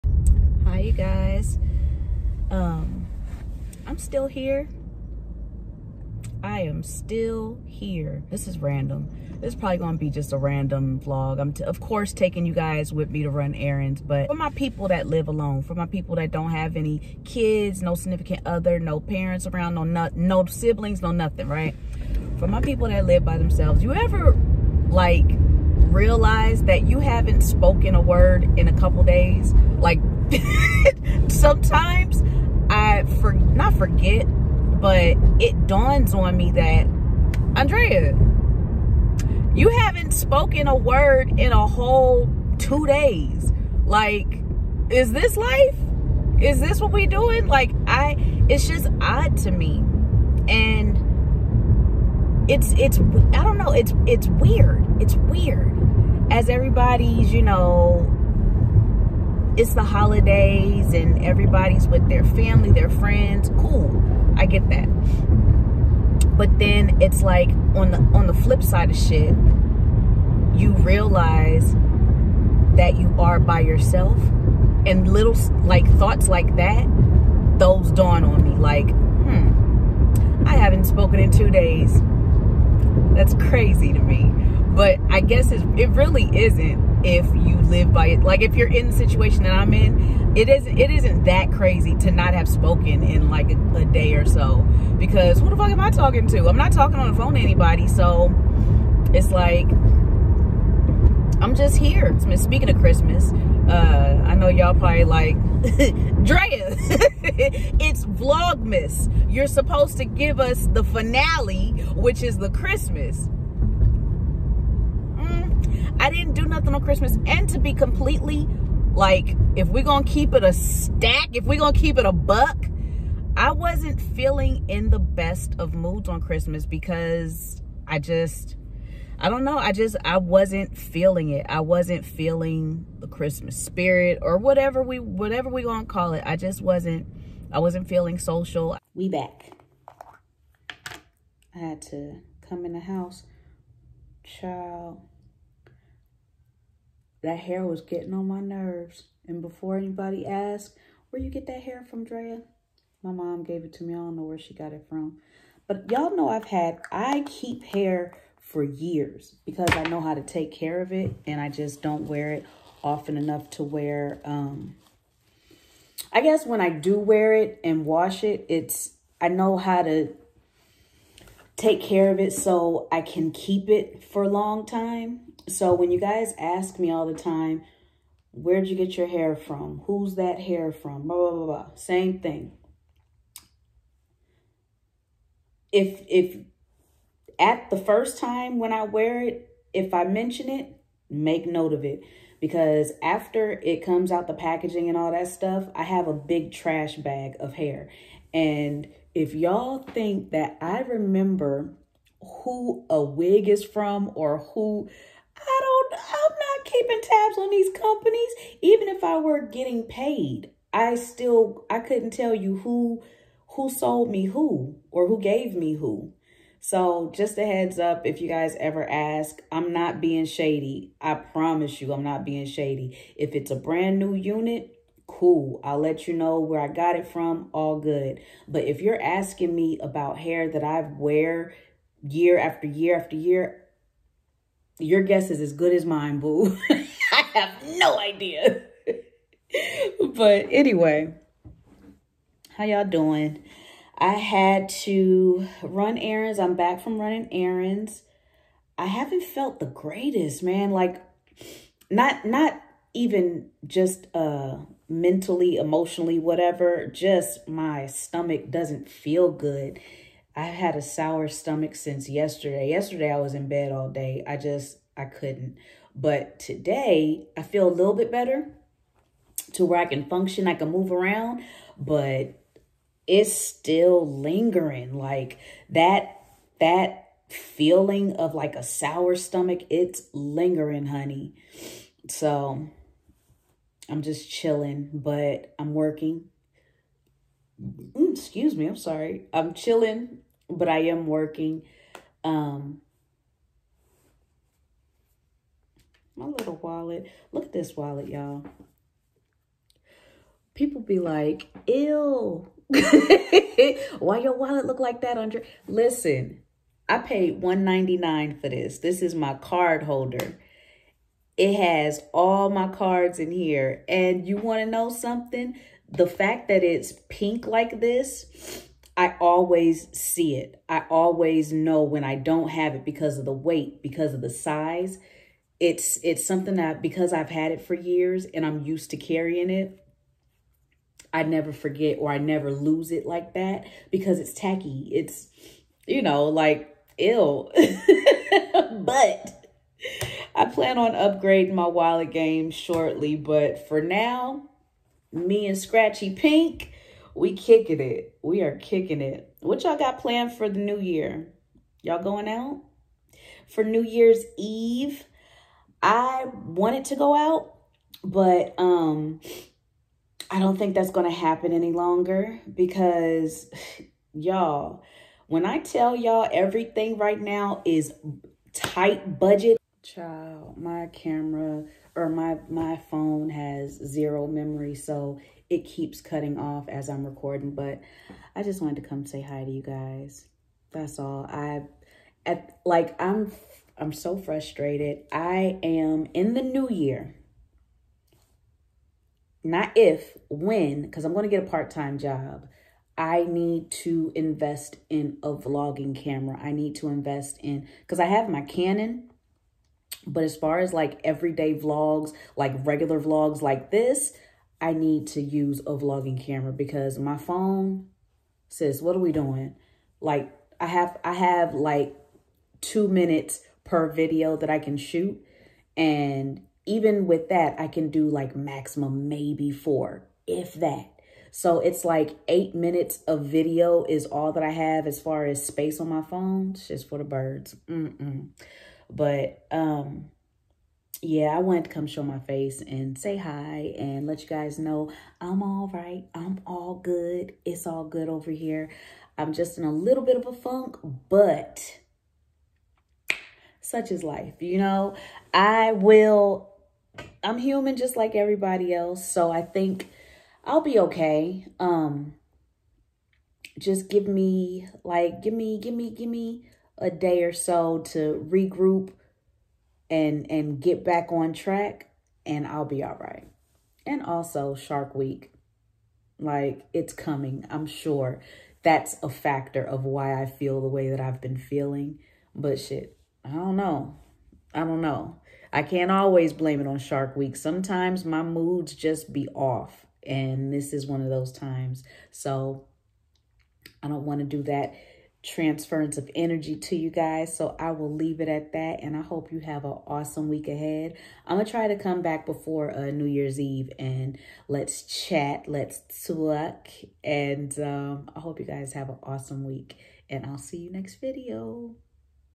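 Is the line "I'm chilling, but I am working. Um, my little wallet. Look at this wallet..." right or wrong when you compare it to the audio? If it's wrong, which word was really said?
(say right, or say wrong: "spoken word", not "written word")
right.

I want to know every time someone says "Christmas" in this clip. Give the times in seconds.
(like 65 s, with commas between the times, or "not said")
102 s, 112 s, 116 s, 126 s, 133 s.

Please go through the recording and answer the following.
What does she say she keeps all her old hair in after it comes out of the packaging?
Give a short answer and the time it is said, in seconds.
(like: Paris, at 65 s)
A big trash bag, at 196 s.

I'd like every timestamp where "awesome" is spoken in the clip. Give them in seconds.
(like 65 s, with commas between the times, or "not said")
489 s, 499 s.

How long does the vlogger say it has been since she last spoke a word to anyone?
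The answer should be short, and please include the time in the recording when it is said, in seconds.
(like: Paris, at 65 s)
2 days, at 41 s.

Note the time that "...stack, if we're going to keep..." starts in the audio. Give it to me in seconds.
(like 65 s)
120 s.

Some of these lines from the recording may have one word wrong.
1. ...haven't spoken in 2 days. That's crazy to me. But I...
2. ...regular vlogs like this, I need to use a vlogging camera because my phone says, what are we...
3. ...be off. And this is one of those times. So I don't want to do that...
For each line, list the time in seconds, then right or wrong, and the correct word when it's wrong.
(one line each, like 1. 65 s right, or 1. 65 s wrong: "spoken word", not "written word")
1. 80 s right
2. 402 s right
3. 479 s right.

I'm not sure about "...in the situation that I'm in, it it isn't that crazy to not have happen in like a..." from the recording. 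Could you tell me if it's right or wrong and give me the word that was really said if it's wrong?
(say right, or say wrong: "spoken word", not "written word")
wrong: "spoken", not "happen".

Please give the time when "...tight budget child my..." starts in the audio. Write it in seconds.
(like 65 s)
368 s.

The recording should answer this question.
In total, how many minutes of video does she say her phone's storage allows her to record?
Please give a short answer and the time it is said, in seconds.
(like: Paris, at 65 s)
8 minutes, at 422 s.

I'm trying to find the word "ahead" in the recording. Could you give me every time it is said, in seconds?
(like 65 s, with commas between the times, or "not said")
490 s.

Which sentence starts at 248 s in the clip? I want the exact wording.
I haven't felt the greatest, man.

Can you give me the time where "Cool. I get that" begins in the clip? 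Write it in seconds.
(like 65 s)
63 s.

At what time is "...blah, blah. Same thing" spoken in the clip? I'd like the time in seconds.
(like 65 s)
181 s.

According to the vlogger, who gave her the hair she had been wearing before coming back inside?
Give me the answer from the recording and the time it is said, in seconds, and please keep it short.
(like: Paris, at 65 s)
My mom, at 153 s.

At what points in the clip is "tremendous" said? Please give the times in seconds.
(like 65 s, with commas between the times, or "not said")
not said.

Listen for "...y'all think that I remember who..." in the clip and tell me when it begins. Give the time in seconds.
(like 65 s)
199 s.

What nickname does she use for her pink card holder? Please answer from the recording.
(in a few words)
Scratchy Pink.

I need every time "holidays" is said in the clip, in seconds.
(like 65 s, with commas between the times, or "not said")
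59 s.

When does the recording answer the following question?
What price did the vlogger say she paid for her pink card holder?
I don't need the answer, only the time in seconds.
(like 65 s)
307 s.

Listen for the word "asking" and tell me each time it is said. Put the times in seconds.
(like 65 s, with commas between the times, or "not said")
229 s.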